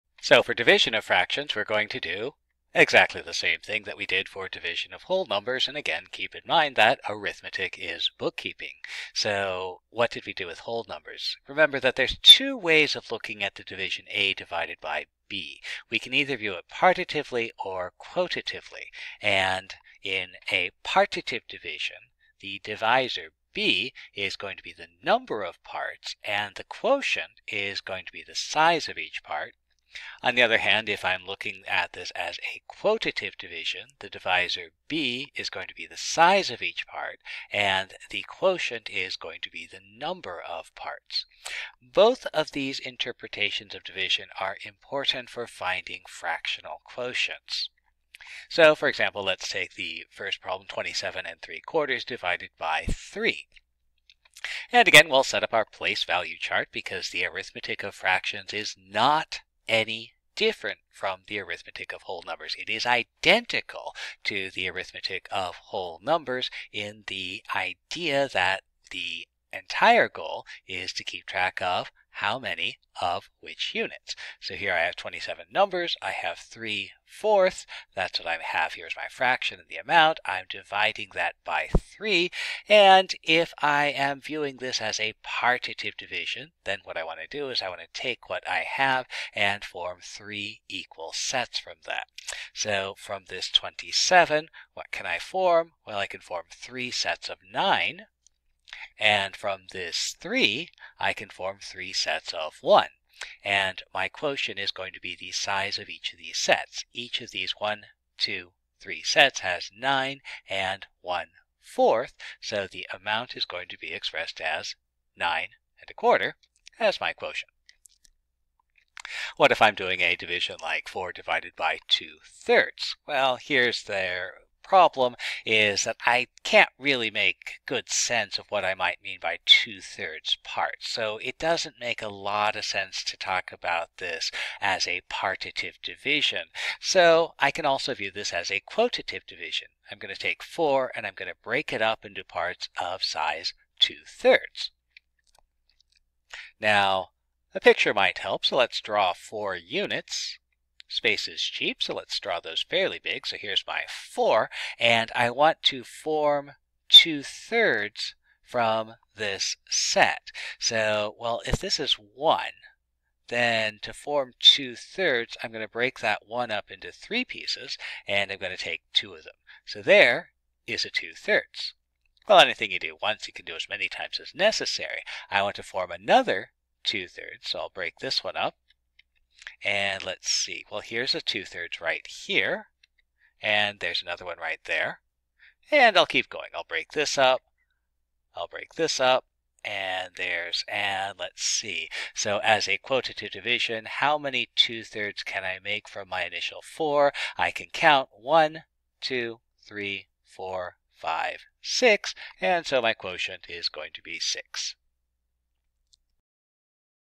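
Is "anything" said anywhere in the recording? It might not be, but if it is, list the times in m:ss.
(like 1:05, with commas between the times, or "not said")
2:52.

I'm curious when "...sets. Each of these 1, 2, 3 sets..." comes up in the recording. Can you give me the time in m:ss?
1:46.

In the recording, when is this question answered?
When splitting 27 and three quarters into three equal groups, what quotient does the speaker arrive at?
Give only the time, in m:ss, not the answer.
1:55.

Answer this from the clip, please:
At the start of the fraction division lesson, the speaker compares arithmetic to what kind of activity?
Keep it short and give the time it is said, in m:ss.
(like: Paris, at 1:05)
bookkeeping, at 0:08.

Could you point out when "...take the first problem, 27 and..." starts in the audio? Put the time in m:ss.
0:49.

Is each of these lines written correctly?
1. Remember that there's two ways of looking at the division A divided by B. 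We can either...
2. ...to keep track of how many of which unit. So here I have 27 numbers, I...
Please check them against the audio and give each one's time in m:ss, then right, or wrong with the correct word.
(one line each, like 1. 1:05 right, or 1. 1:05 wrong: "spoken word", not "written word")
1. 0:11 right
2. 1:10 right.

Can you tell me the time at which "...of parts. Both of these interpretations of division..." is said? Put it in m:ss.
0:40.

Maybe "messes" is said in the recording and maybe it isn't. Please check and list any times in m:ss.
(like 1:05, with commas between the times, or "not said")
not said.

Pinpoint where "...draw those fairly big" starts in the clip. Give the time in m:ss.
2:32.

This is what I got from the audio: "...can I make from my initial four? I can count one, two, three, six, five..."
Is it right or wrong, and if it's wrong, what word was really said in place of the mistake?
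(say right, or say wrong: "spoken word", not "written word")
wrong: "four", not "six".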